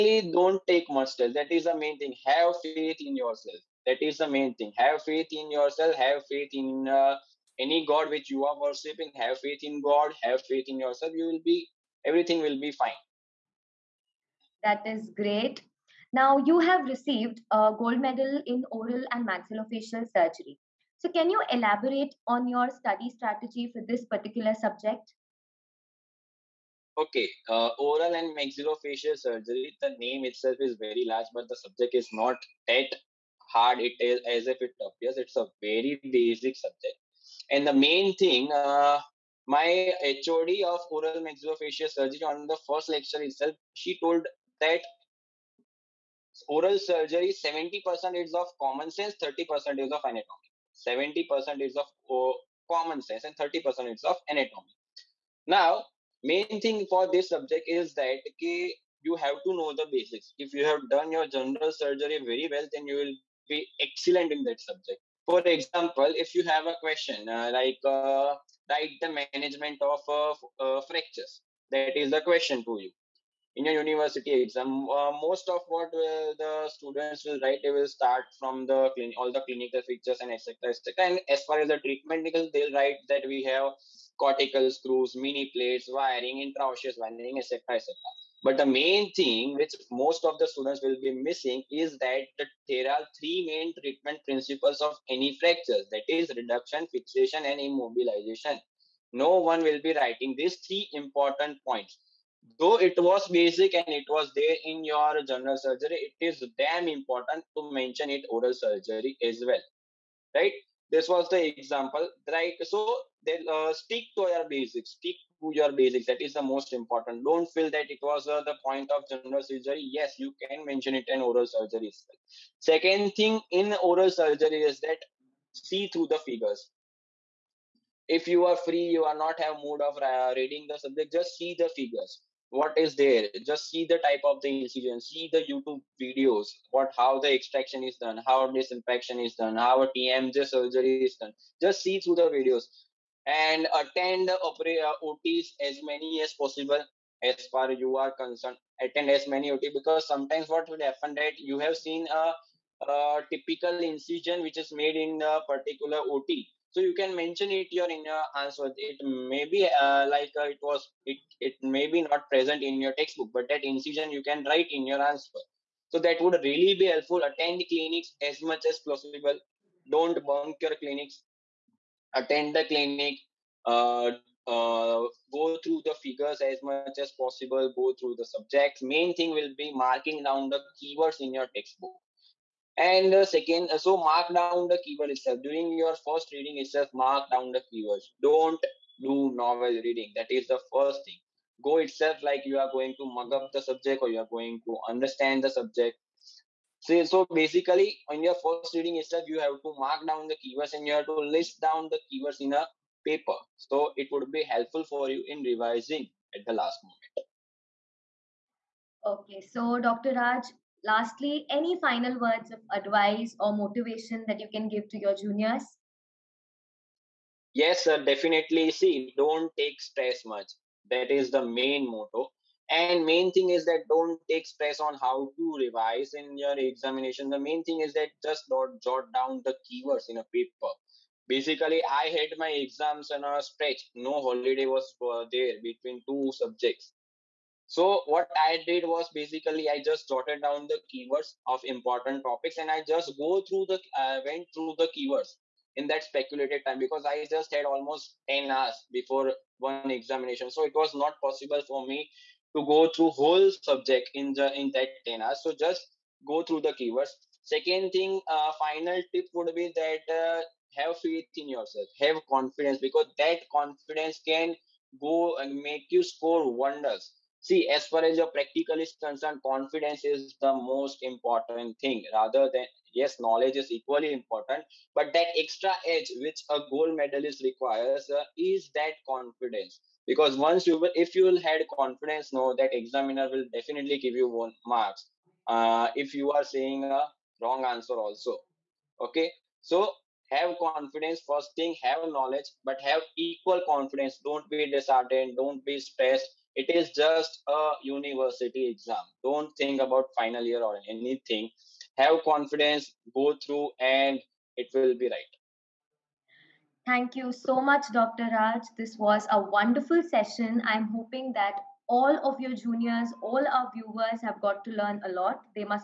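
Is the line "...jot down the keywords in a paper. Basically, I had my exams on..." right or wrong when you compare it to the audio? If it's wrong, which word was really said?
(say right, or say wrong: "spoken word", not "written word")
right.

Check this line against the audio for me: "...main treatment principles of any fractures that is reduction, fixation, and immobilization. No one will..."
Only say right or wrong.
right.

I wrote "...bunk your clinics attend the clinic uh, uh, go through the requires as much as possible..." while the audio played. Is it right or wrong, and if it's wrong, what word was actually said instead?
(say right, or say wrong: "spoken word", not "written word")
wrong: "figures", not "requires".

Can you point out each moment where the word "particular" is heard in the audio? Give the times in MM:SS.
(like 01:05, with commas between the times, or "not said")
00:24, 02:35.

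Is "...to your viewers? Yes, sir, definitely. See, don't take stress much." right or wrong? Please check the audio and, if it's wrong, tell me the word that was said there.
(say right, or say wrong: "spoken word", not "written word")
wrong: "juniors", not "viewers".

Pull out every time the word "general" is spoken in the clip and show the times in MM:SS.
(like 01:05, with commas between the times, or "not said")
01:01, 01:45, 01:59.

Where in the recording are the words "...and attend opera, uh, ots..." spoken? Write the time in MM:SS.
02:23.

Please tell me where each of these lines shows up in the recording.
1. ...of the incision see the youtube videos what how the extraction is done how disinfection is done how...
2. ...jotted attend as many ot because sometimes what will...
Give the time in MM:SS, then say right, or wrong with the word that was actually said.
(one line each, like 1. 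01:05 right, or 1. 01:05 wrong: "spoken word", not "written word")
1. 02:14 right
2. 02:28 wrong: "concerned", not "jotted".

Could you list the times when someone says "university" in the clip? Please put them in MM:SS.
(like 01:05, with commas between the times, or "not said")
01:13, 04:57.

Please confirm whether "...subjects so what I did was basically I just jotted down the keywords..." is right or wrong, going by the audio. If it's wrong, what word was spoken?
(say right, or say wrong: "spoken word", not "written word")
right.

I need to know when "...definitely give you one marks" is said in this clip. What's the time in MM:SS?
04:43.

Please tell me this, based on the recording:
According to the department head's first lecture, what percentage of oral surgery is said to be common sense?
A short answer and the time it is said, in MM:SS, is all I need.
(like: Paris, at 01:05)
70%, at 00:47.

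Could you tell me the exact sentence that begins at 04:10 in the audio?
So it was not possible for me to go through whole subject in the in that 10 hours.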